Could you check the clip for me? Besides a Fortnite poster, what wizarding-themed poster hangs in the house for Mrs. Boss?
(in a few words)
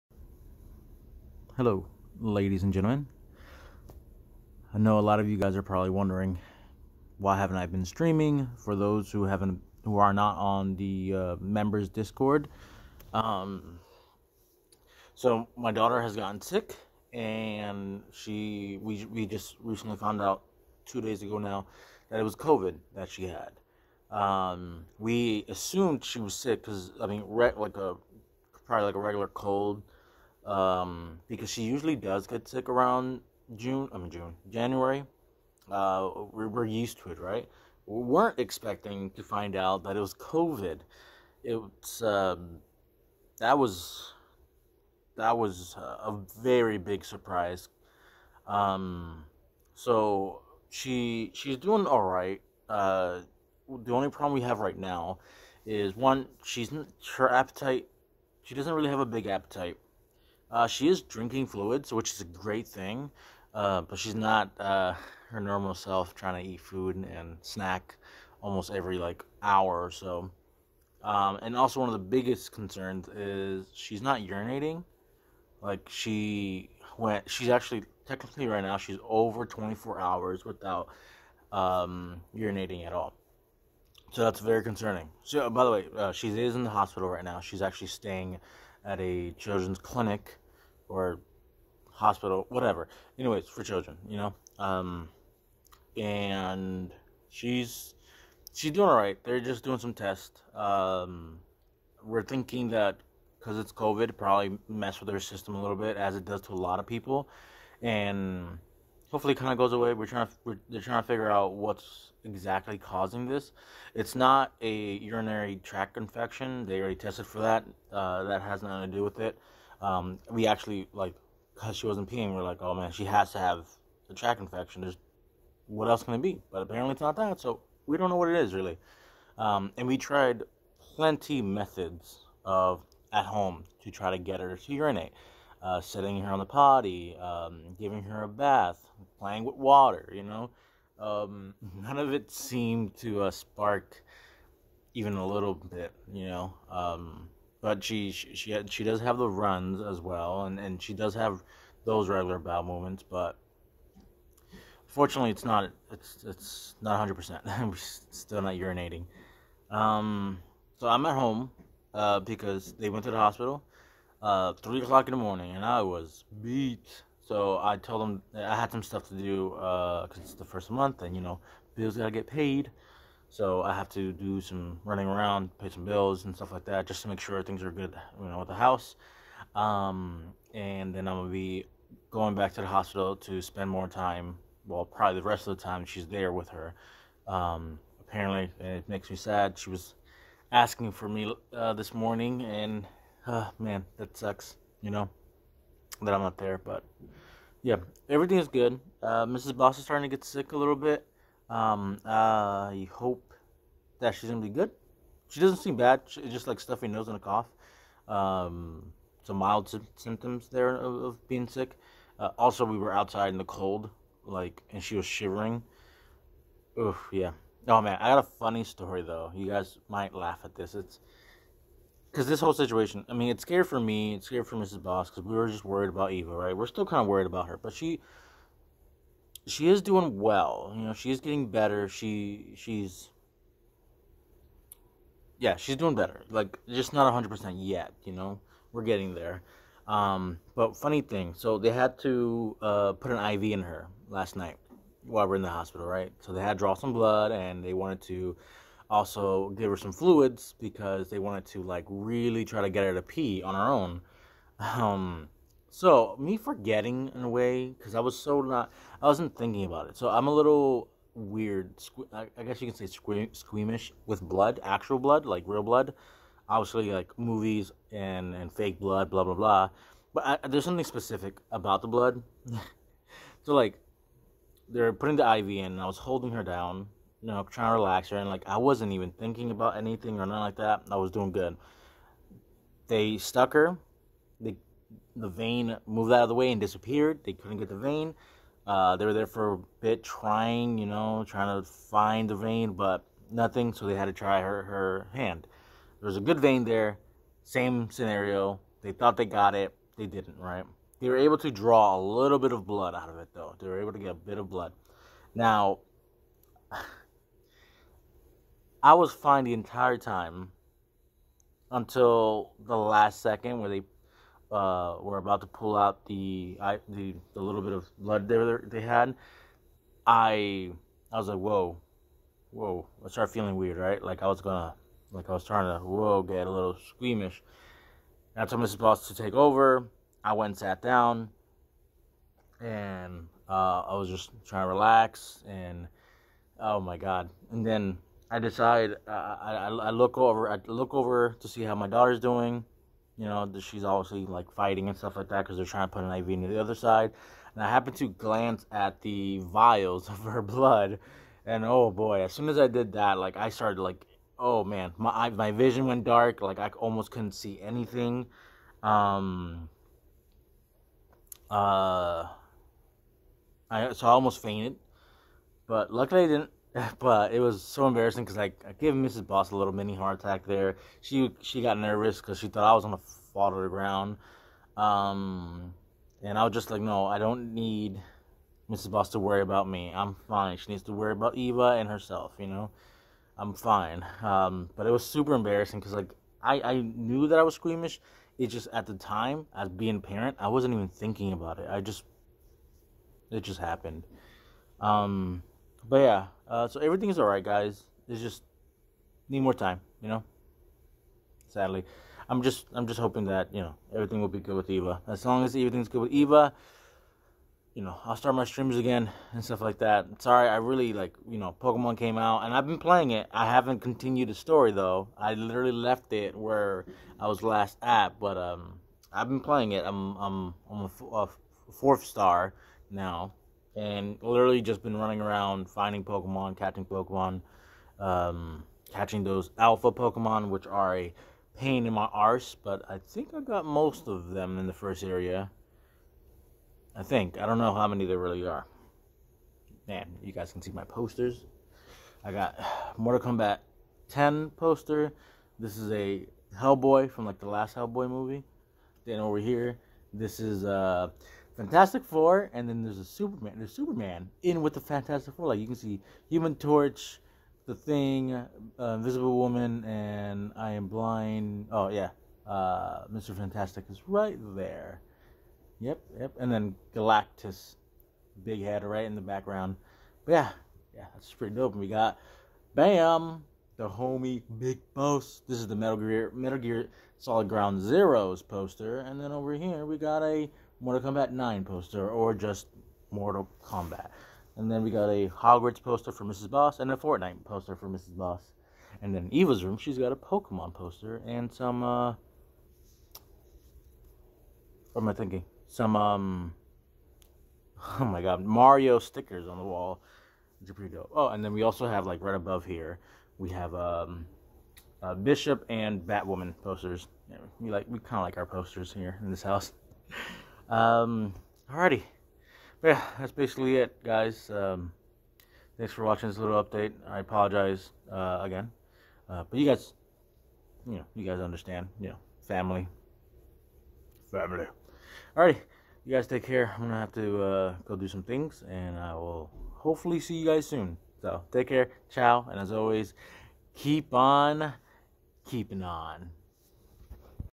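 Hogwarts.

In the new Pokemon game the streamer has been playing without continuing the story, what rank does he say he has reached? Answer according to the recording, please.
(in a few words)
fourth star.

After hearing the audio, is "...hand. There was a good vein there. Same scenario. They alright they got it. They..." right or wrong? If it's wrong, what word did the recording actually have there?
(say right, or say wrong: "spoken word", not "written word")
wrong: "thought", not "alright".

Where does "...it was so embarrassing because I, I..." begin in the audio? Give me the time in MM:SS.
06:07.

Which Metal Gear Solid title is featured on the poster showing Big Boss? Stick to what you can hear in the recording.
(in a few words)
Ground Zeroes.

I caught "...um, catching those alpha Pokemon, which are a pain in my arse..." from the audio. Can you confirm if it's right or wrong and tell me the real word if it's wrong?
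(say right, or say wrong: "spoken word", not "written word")
right.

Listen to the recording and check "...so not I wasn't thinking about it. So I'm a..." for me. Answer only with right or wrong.
right.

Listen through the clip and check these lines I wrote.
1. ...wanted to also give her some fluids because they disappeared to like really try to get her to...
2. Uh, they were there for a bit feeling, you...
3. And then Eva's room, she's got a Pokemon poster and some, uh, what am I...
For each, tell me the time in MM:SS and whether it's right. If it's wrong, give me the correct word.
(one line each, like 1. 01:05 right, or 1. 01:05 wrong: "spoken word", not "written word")
1. 04:07 wrong: "wanted", not "disappeared"
2. 04:48 wrong: "trying", not "feeling"
3. 08:09 right.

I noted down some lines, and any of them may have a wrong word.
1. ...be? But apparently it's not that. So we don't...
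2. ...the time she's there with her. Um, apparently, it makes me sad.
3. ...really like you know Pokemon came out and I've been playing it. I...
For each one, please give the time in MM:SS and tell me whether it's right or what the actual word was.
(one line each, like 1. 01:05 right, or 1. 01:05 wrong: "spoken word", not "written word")
1. 02:06 right
2. 03:05 right
3. 06:50 right.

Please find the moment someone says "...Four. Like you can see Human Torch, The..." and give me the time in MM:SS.
07:35.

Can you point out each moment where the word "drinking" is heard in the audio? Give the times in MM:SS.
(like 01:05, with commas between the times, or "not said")
01:01.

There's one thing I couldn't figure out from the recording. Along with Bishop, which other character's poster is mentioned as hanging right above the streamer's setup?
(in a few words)
Batwoman.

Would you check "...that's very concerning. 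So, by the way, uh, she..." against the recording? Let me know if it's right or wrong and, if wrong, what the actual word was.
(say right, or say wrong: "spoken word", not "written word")
right.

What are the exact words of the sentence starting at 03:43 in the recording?
I mean, it's scary for me.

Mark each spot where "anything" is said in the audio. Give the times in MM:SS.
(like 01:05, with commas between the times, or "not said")
04:39, 05:57.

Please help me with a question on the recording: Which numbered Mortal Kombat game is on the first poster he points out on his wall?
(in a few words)
Mortal Kombat 10.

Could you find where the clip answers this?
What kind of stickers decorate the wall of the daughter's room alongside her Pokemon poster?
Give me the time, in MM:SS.
08:18.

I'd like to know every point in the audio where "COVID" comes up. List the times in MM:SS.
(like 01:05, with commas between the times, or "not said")
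00:22, 00:40, 01:43.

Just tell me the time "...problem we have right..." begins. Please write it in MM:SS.
00:54.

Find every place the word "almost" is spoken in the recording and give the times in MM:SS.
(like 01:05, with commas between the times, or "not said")
01:08, 05:56, 06:04.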